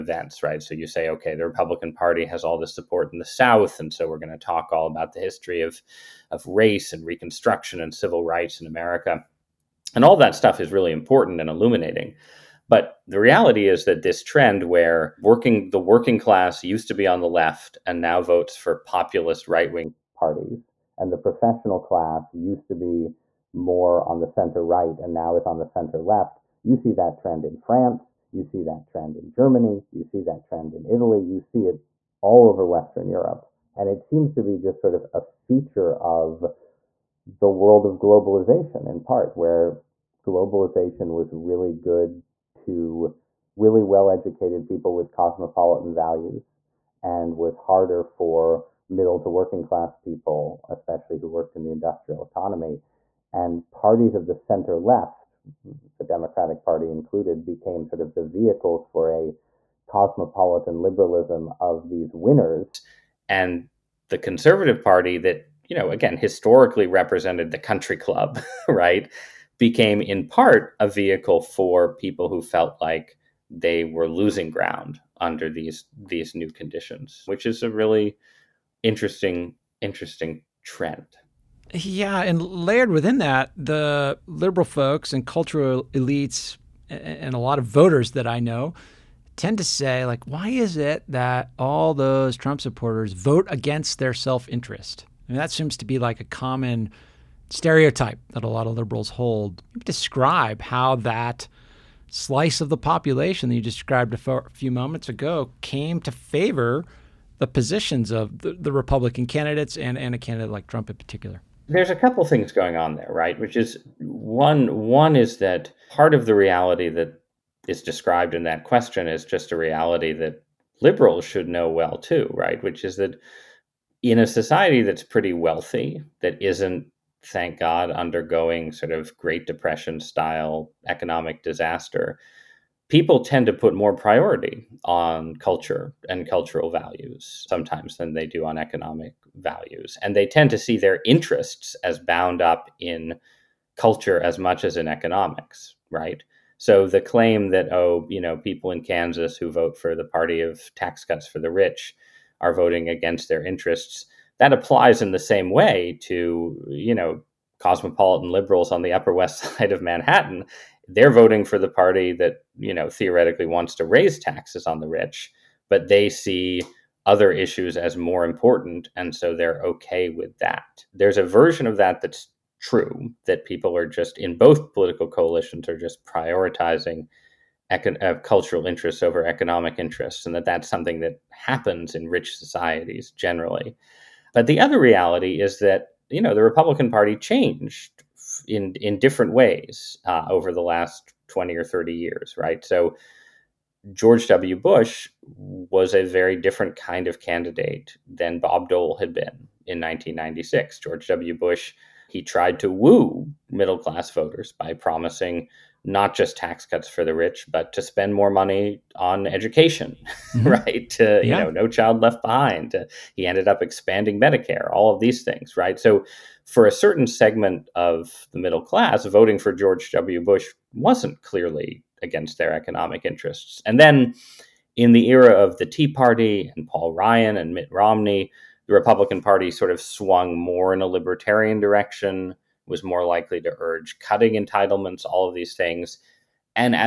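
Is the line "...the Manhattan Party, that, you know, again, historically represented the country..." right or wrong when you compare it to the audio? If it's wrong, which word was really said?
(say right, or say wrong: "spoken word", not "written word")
wrong: "Conservative", not "Manhattan".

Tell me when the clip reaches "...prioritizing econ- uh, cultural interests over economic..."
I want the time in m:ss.
2:56.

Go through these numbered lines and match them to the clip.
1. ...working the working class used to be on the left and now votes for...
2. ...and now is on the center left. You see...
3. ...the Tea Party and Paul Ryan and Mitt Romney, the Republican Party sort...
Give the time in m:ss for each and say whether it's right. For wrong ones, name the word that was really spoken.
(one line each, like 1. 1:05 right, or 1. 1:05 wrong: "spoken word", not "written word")
1. 0:15 right
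2. 0:24 right
3. 3:45 right.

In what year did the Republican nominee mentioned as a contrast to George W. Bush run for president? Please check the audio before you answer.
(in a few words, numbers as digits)
1996.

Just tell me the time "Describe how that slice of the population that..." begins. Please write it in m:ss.
1:39.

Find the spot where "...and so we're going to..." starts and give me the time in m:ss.
0:03.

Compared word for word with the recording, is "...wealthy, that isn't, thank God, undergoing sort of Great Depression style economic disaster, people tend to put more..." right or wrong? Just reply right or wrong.
right.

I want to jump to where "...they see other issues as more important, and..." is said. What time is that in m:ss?
2:45.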